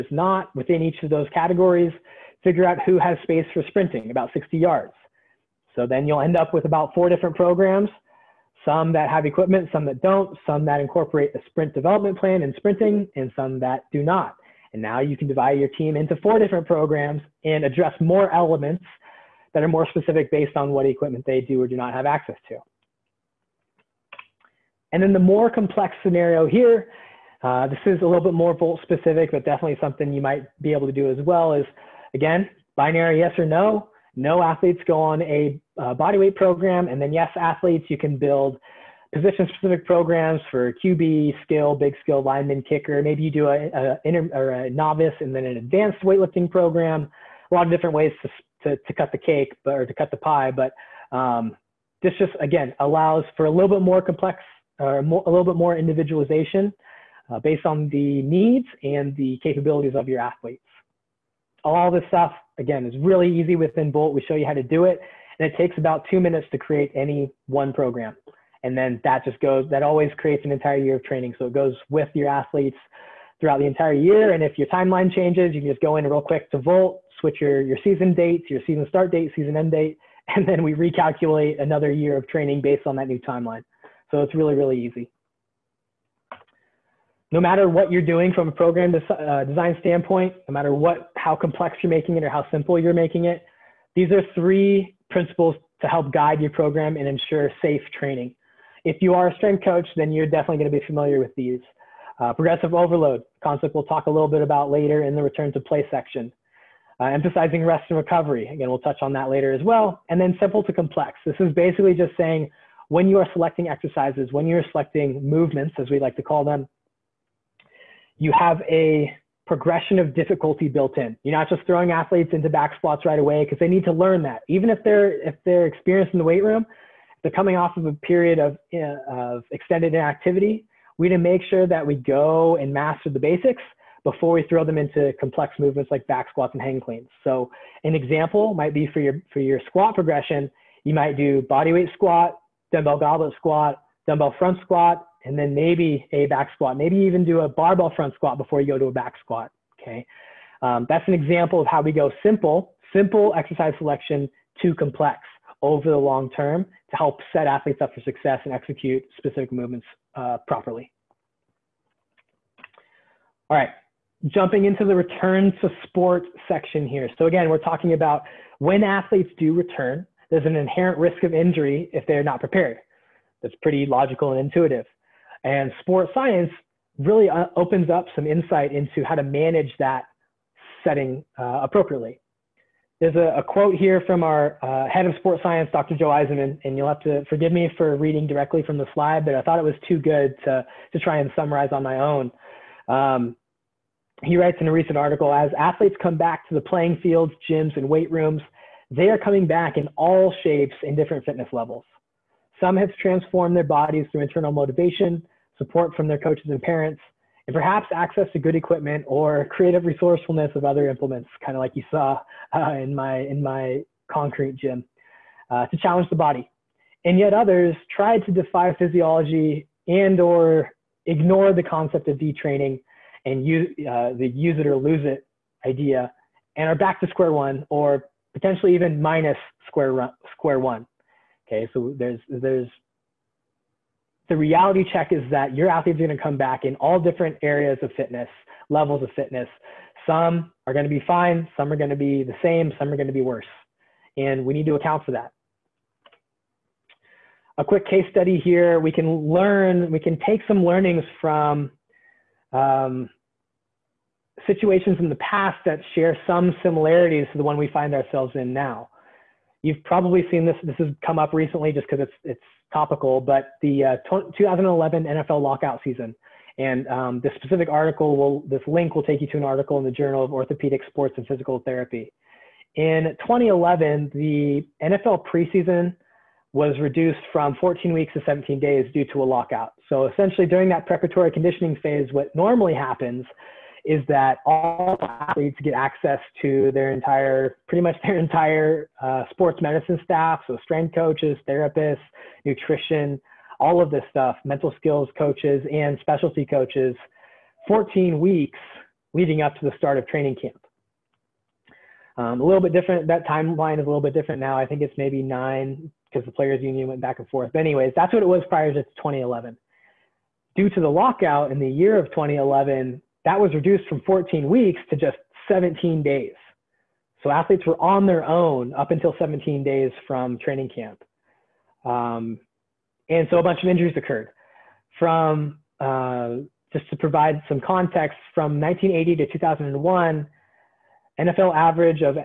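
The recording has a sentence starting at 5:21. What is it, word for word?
Um, and so a bunch of injuries occurred.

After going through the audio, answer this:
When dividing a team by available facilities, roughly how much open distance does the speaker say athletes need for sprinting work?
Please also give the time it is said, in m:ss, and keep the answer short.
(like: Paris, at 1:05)
60 yards, at 0:04.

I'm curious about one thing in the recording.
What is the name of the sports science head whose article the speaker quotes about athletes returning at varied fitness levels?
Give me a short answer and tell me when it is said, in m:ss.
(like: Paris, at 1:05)
Dr. Joe Eisenmann, at 3:05.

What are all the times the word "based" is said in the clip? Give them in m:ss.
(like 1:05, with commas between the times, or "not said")
0:20, 0:57, 1:22.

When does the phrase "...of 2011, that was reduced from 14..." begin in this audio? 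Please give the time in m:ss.
5:11.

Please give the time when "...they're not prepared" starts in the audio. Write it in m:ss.
2:52.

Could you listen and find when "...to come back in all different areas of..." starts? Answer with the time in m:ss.
3:56.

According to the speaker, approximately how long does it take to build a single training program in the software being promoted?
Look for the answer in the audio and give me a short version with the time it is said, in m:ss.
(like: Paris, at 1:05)
2 minutes, at 1:05.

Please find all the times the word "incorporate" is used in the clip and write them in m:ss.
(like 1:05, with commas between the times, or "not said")
0:10.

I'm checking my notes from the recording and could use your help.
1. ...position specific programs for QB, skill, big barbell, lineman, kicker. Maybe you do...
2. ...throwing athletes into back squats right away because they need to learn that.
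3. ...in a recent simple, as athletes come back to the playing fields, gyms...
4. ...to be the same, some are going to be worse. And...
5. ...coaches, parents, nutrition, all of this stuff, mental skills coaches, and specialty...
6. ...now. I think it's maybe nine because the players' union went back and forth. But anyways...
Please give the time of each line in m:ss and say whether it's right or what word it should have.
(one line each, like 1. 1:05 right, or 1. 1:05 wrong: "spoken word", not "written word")
1. 0:39 wrong: "skill", not "barbell"
2. 2:01 right
3. 3:14 wrong: "article", not "simple"
4. 4:01 right
5. 4:50 wrong: "therapists", not "parents"
6. 5:04 right.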